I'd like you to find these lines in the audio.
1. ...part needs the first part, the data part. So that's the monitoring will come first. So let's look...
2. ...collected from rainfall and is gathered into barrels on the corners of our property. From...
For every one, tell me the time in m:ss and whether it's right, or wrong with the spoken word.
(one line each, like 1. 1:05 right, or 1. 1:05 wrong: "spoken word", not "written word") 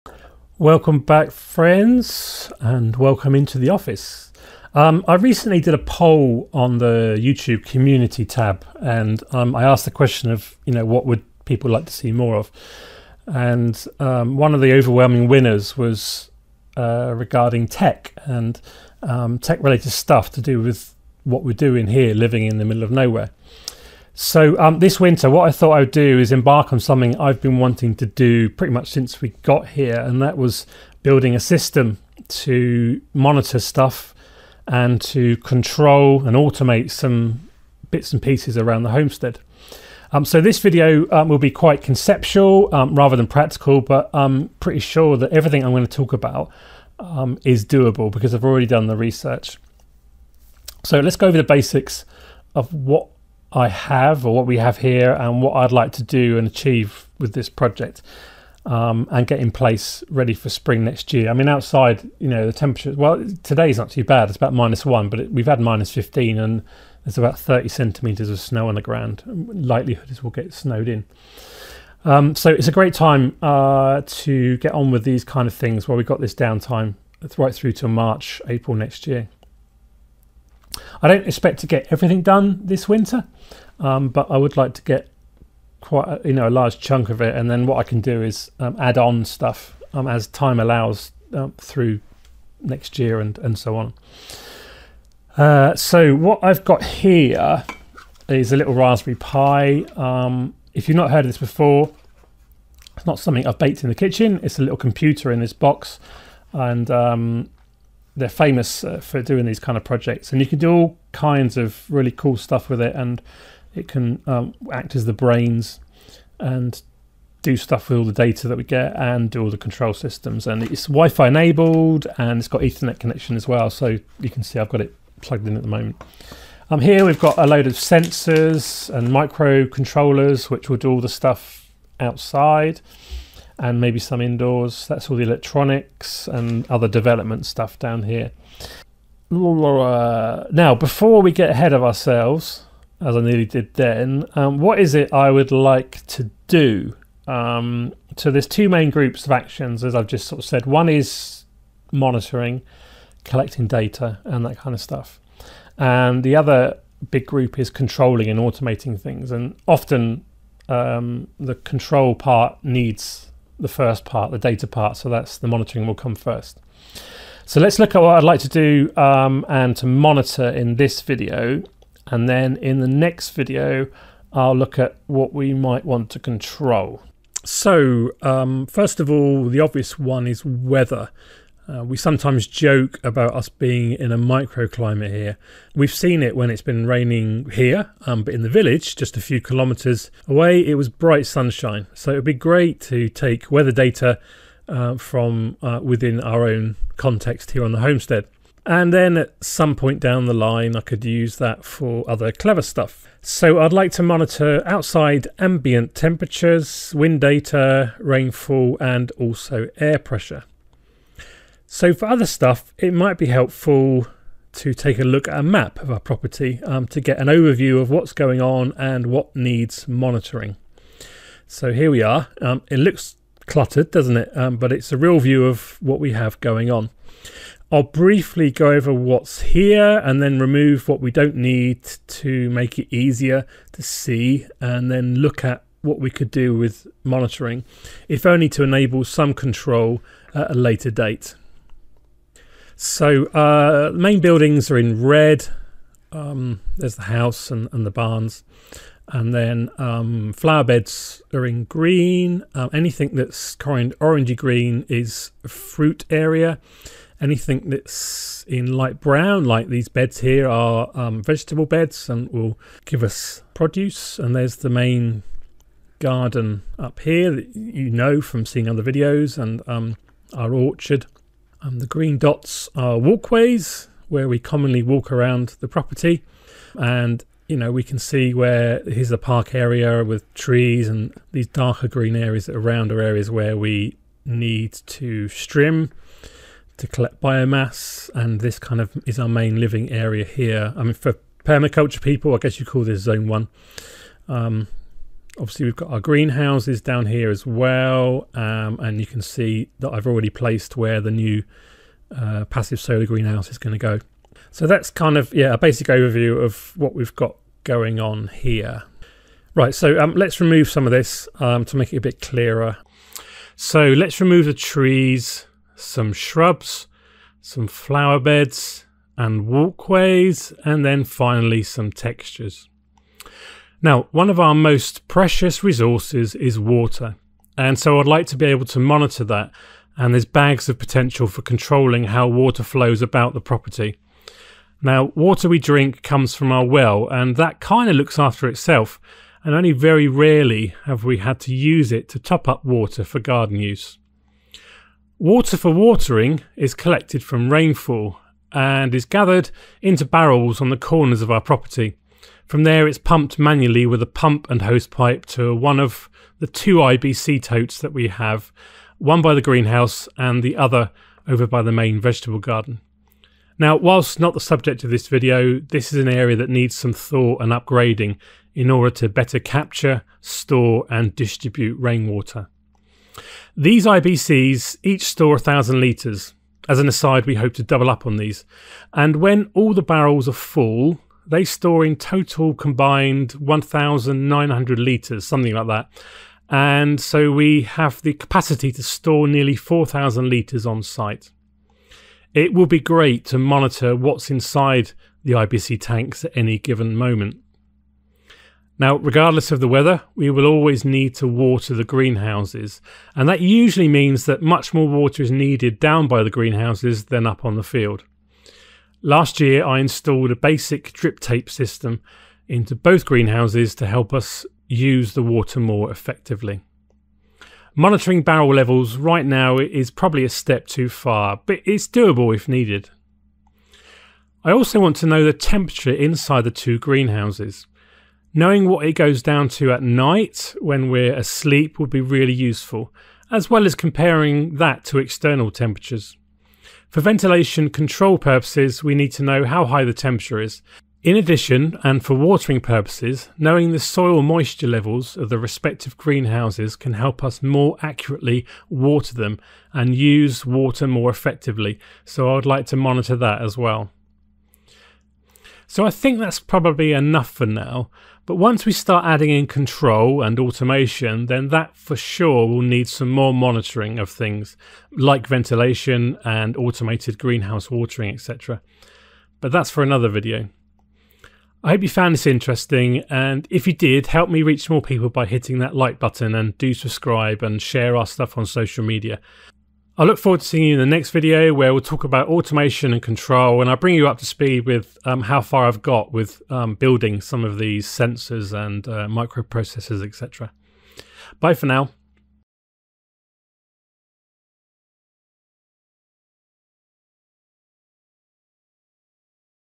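1. 2:42 right
2. 5:46 right.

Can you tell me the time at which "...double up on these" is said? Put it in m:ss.
6:17.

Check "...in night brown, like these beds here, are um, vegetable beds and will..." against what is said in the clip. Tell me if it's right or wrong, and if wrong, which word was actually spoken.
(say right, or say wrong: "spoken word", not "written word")
wrong: "light", not "night".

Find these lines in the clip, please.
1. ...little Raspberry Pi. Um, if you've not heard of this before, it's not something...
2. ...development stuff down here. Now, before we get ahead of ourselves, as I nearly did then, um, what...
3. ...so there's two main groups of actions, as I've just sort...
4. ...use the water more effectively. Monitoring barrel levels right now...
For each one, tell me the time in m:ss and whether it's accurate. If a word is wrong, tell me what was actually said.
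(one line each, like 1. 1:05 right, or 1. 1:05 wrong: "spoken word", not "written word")
1. 1:38 right
2. 2:16 right
3. 2:28 right
4. 6:54 right.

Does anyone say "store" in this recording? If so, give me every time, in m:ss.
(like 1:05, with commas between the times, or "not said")
6:10, 6:15, 6:21, 6:28.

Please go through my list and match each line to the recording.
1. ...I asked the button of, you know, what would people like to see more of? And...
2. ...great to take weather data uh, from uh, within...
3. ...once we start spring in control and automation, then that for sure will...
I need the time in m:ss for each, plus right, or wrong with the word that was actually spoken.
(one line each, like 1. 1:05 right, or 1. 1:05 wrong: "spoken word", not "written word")
1. 0:09 wrong: "question", not "button"
2. 3:12 right
3. 7:38 wrong: "adding", not "spring".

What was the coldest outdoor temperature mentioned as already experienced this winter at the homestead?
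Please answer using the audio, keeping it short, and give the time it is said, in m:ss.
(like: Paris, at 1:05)
Minus 15, at 1:05.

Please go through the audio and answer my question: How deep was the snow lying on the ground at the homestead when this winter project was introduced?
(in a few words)
30 centimetres.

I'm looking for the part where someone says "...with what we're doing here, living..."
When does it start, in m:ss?
0:20.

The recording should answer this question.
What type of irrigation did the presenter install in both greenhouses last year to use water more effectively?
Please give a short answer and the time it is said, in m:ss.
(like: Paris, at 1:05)
Drip tape, at 6:50.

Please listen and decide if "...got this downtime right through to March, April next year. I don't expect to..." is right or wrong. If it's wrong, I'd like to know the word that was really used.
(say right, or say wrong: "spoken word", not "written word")
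right.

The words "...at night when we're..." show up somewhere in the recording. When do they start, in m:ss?
7:09.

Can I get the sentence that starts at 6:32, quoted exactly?
It will be great to monitor what's inside the IBC tanks at any given moment.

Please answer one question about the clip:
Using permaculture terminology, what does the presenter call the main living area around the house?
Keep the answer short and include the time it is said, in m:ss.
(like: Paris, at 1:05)
Zone one, at 4:53.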